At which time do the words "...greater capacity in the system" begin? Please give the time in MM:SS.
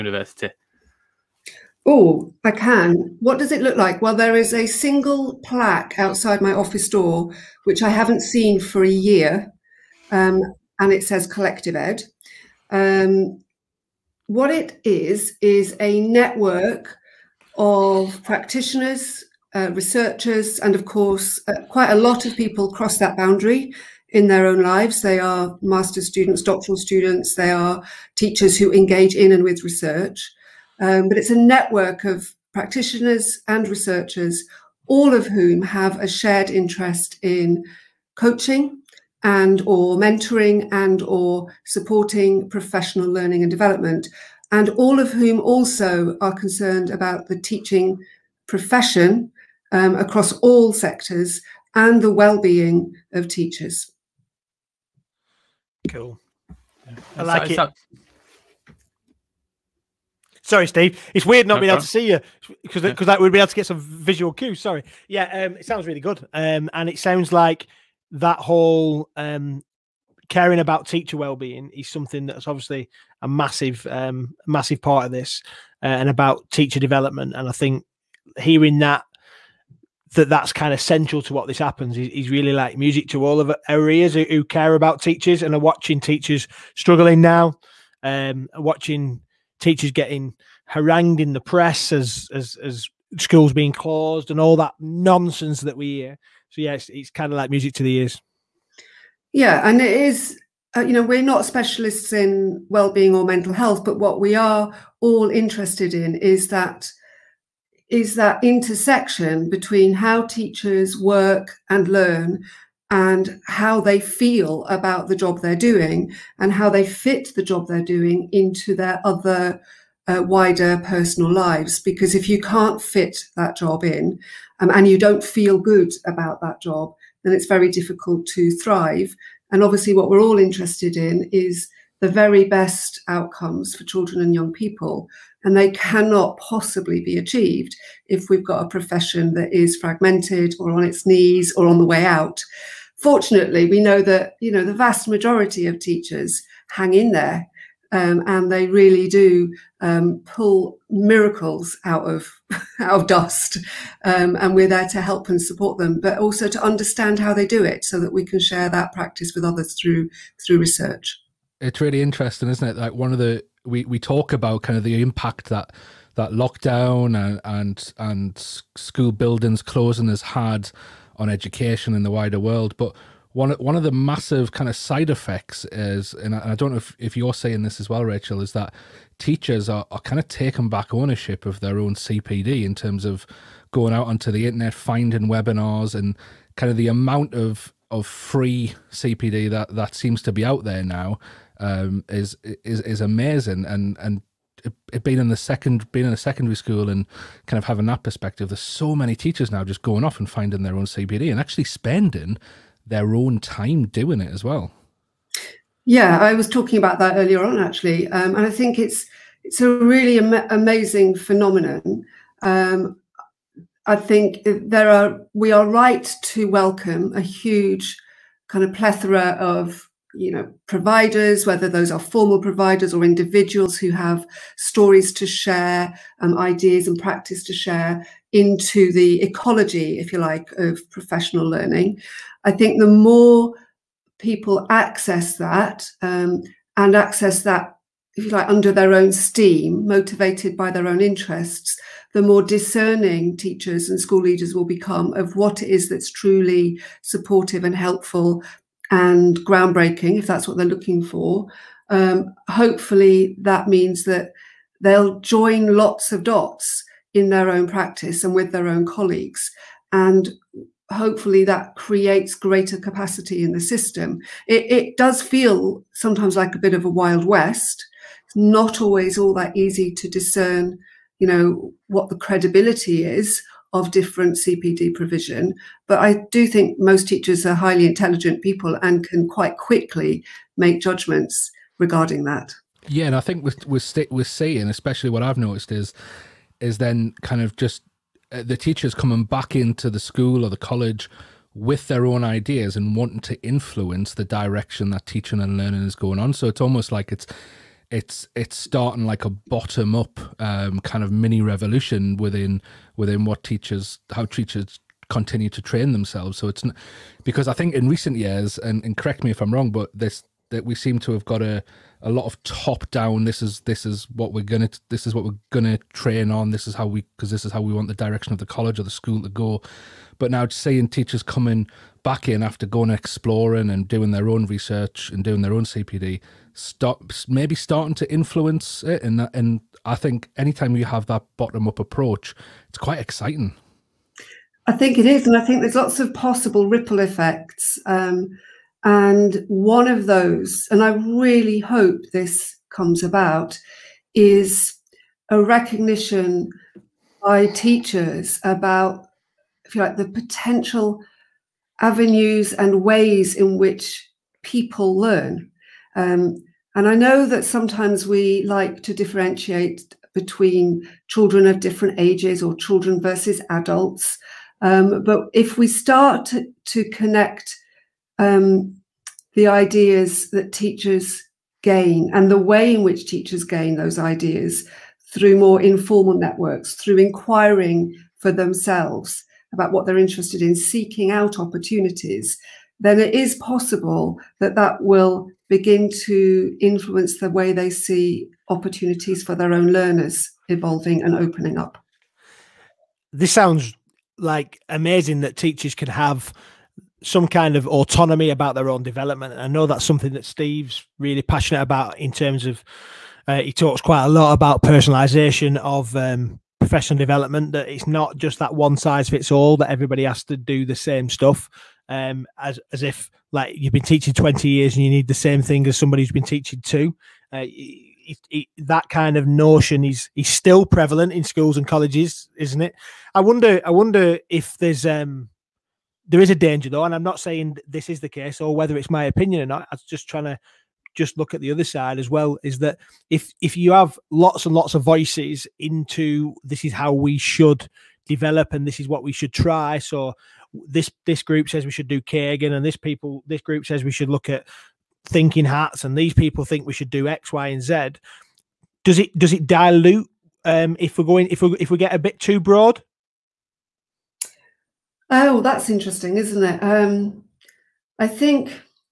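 04:22.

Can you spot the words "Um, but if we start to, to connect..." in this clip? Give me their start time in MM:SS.
06:04.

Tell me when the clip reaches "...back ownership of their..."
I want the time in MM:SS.
03:00.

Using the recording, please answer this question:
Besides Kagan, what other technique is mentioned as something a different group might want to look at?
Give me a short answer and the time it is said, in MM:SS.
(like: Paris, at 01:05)
thinking hats, at 07:25.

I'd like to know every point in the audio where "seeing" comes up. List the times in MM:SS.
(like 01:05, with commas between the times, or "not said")
04:44, 05:20.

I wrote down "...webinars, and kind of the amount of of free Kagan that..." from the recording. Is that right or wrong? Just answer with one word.
wrong.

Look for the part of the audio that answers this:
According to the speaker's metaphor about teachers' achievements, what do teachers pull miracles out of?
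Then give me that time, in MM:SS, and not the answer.
02:32.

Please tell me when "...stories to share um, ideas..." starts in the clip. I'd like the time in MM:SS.
03:44.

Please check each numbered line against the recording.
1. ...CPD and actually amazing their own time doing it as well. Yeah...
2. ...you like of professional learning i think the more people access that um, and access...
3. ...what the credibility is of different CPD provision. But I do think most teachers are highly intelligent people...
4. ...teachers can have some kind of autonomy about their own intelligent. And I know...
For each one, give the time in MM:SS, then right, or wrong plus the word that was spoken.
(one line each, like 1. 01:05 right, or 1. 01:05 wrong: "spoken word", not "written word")
1. 03:20 wrong: "spending", not "amazing"
2. 03:50 right
3. 04:31 right
4. 06:35 wrong: "development", not "intelligent".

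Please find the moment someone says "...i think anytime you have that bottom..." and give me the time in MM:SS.
05:29.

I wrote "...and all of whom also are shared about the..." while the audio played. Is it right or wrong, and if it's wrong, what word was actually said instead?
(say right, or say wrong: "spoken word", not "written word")
wrong: "concerned", not "shared".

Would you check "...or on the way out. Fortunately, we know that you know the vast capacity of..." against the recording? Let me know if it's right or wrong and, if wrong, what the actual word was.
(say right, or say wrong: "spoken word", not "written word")
wrong: "majority", not "capacity".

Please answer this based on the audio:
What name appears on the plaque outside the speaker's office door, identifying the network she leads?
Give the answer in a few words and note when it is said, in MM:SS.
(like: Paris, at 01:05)
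CollectivED, at 00:11.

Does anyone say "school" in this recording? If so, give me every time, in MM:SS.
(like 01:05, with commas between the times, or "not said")
01:33, 02:48, 03:16, 04:03, 04:49, 05:18, 07:01.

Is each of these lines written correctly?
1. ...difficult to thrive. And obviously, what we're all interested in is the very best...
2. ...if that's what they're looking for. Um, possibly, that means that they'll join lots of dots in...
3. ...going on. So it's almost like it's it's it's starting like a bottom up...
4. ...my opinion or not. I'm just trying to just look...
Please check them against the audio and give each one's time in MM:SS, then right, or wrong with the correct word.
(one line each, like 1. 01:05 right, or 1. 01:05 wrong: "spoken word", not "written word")
1. 02:07 right
2. 04:10 wrong: "hopefully", not "possibly"
3. 04:55 right
4. 07:08 right.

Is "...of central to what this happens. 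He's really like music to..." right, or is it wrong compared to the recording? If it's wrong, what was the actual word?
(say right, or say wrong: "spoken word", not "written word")
right.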